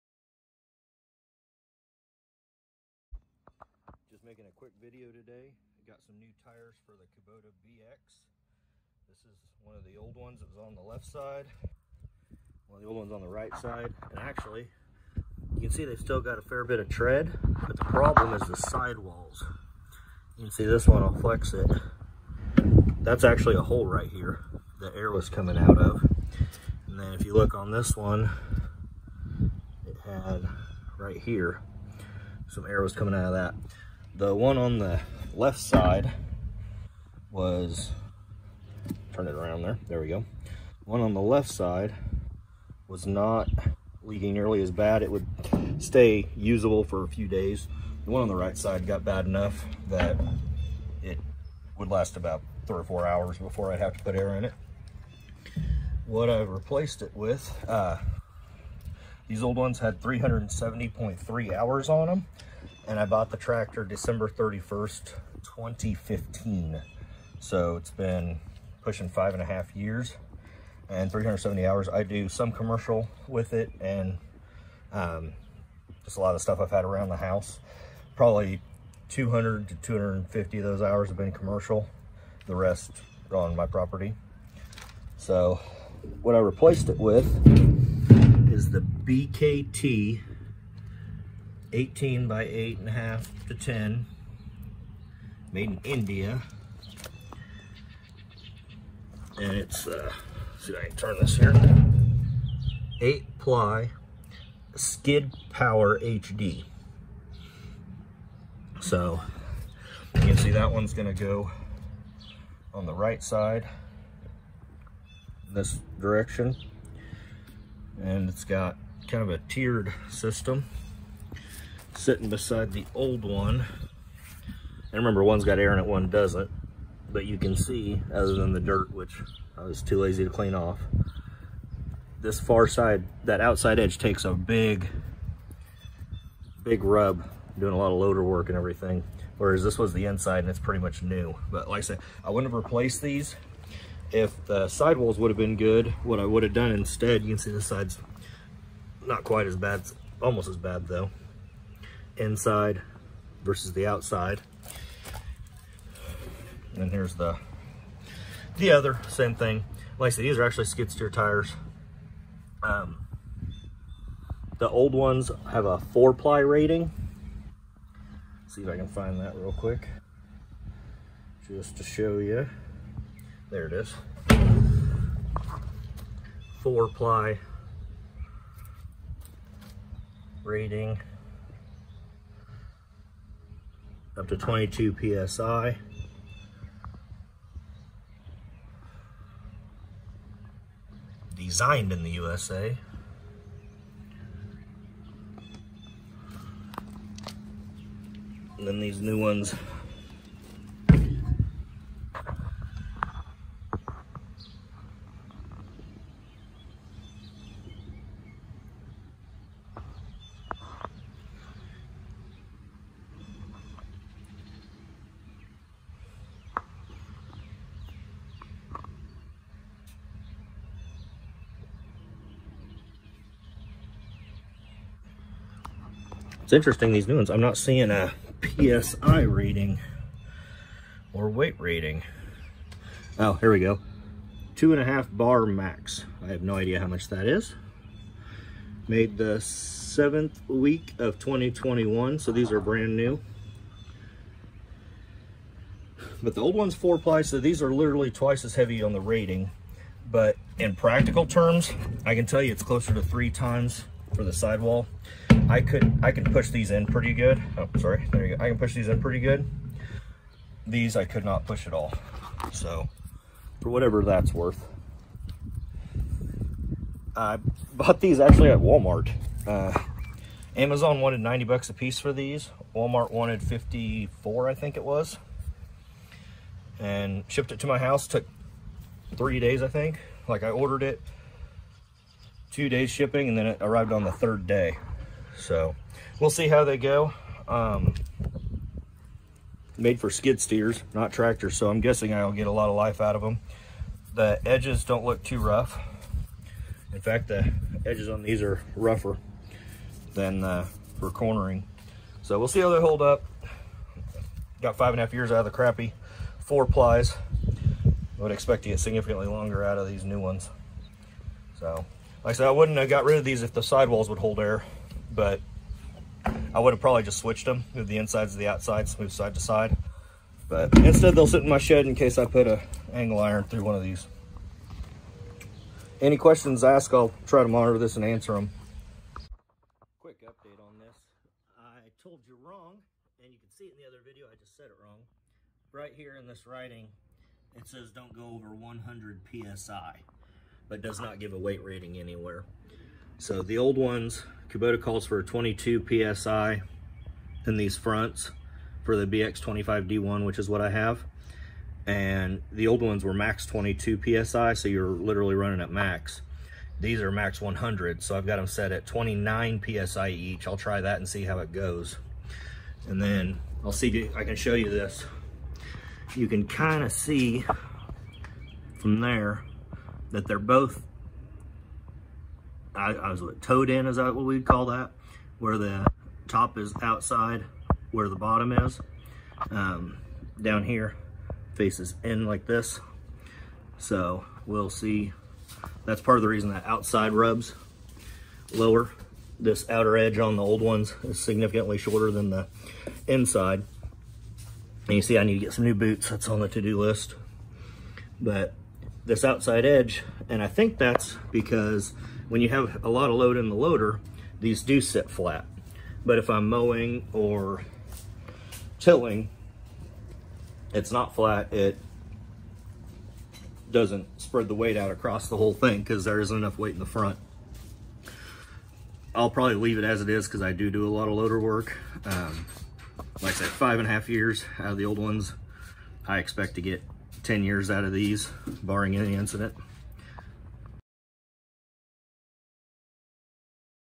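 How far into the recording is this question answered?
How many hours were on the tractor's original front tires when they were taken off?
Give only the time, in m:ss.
1:00.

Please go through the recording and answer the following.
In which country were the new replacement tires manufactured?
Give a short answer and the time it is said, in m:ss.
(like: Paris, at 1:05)
India, at 1:35.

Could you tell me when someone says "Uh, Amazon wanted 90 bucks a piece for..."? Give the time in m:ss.
4:29.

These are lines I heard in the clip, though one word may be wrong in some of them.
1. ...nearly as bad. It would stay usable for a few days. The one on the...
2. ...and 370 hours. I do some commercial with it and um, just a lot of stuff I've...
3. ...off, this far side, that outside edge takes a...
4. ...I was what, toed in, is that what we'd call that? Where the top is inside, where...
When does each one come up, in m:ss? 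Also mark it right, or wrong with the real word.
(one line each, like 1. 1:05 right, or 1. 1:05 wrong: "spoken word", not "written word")
1. 0:44 right
2. 1:10 right
3. 2:10 right
4. 6:12 wrong: "outside", not "inside".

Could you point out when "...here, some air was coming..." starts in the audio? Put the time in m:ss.
0:31.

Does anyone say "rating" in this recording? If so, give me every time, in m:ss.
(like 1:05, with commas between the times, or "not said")
2:46, 3:00, 3:51, 4:08, 5:41.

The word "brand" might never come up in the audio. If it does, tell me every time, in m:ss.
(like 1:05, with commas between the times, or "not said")
4:02.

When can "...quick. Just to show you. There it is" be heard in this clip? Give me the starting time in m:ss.
2:49.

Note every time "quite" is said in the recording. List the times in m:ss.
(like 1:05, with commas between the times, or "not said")
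2:29.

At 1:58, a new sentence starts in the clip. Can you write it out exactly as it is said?
And it's got kind of a tiered system sitting beside the old one.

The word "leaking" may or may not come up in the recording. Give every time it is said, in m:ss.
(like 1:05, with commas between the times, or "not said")
0:44.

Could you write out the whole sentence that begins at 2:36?
And here's the the other, same thing.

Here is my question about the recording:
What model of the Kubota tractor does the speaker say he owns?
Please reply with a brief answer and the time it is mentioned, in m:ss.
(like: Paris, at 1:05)
BX25D1, at 5:49.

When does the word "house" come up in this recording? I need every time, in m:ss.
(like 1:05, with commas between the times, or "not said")
1:17, 4:37.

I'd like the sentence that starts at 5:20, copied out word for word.
But instead they'll sit in my shed in case I put a angle iron through one of these.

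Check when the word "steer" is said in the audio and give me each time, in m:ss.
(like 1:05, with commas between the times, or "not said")
2:40, 4:50.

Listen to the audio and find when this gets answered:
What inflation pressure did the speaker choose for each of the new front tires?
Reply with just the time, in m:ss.
5:58.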